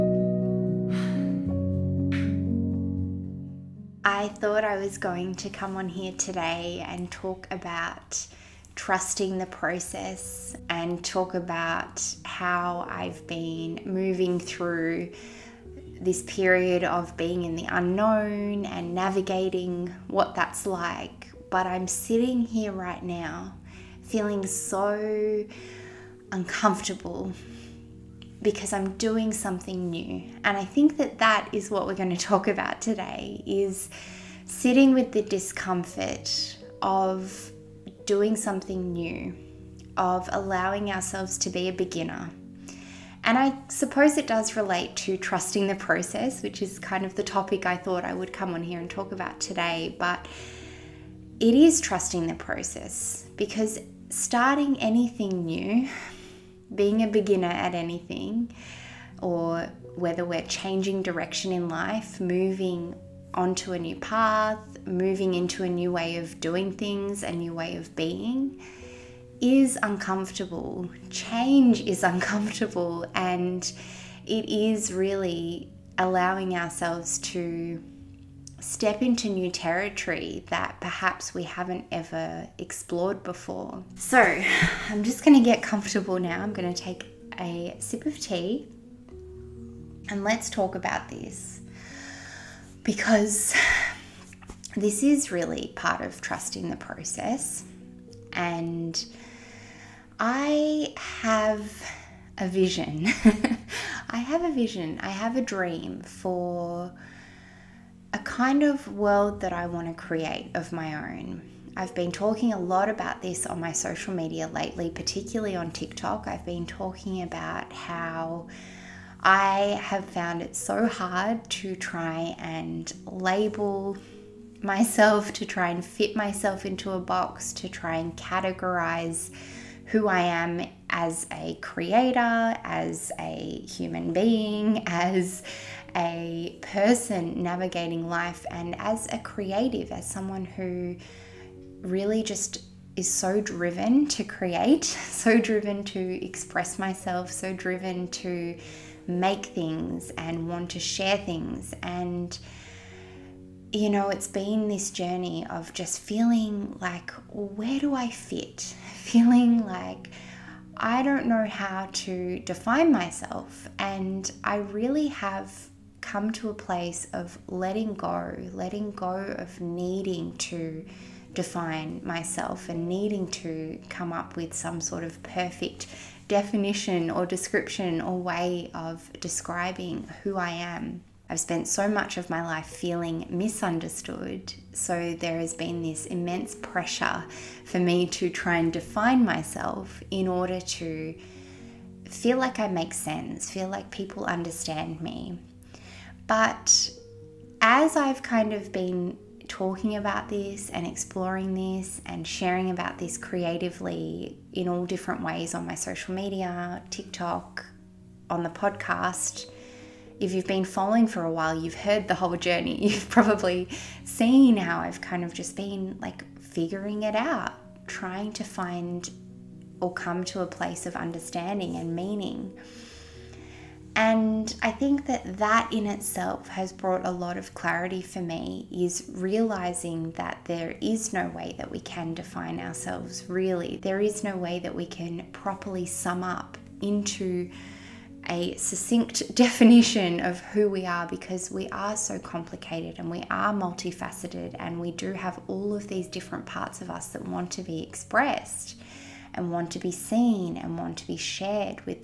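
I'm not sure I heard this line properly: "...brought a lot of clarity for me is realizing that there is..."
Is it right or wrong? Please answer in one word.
right.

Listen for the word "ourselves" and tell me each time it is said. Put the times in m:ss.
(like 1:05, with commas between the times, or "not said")
0:40, 1:16, 3:52.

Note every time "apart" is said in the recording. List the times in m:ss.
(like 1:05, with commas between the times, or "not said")
not said.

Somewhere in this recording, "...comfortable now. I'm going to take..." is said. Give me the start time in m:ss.
1:25.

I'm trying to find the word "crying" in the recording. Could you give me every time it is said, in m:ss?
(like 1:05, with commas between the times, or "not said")
not said.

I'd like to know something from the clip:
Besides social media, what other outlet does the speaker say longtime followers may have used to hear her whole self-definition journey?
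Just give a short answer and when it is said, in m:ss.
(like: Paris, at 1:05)
The podcast, at 3:28.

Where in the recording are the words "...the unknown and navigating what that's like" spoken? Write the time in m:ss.
0:17.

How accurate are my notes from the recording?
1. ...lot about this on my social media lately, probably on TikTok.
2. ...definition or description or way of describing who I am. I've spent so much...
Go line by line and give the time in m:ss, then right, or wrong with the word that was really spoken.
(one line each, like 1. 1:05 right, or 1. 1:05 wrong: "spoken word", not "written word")
1. 1:52 wrong: "particularly", not "probably"
2. 2:56 right.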